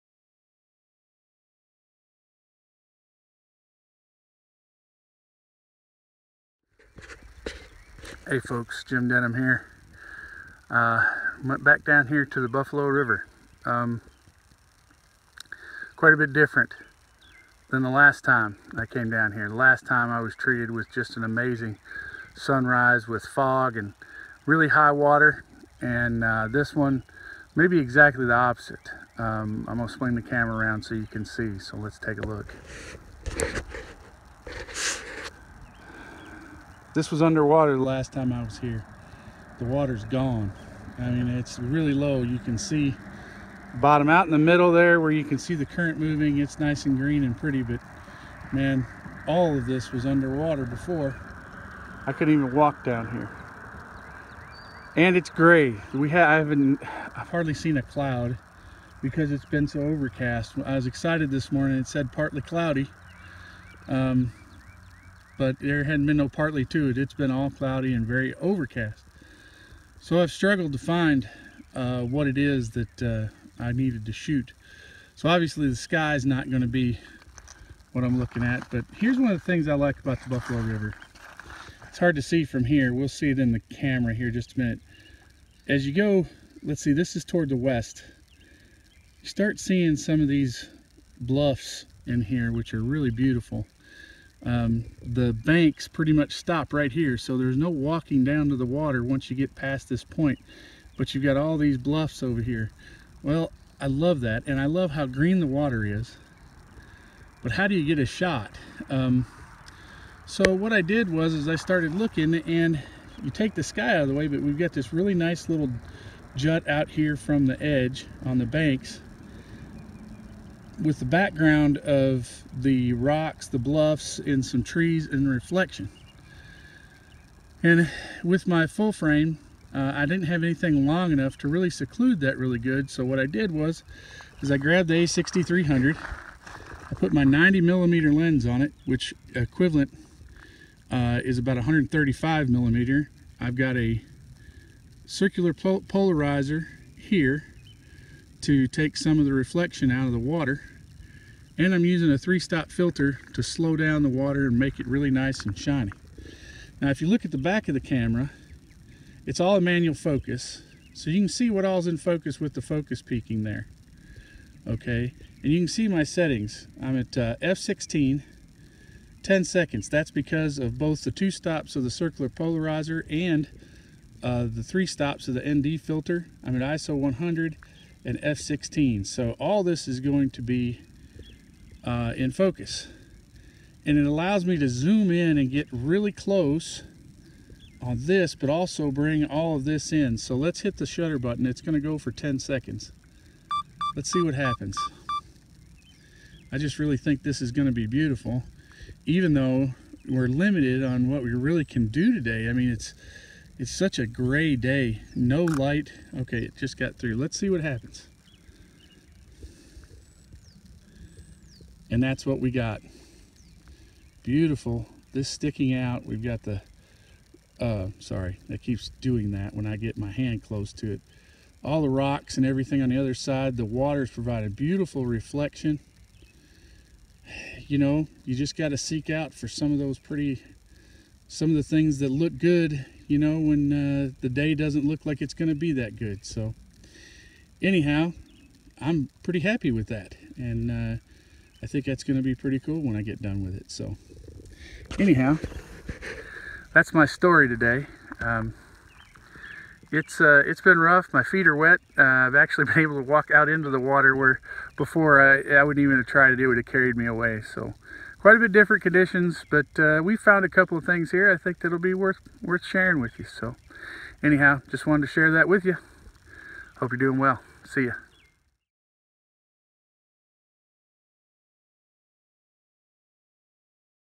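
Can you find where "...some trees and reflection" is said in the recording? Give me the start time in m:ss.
2:04.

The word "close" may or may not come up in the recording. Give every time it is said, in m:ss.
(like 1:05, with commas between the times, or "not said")
3:06, 3:40.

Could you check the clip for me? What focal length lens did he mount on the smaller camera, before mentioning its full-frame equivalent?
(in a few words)
90 millimeter.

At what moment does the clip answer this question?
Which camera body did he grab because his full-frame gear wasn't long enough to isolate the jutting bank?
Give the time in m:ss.
2:15.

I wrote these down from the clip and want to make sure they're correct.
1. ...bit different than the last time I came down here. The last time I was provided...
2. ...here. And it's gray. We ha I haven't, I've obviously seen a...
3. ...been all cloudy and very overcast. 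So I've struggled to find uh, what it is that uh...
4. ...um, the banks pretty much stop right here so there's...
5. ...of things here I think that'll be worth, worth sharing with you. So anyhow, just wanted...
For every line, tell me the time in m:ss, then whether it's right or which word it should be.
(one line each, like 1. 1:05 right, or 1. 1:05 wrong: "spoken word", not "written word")
1. 0:16 wrong: "treated", not "provided"
2. 0:53 wrong: "hardly", not "obviously"
3. 1:07 right
4. 1:34 right
5. 4:20 right.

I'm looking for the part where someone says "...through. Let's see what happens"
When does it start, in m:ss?
3:26.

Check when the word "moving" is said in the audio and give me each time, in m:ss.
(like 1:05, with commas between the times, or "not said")
0:45.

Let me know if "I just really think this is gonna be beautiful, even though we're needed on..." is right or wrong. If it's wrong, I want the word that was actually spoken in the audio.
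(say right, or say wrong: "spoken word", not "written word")
wrong: "limited", not "needed".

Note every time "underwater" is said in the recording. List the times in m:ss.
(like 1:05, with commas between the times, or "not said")
0:37, 0:50.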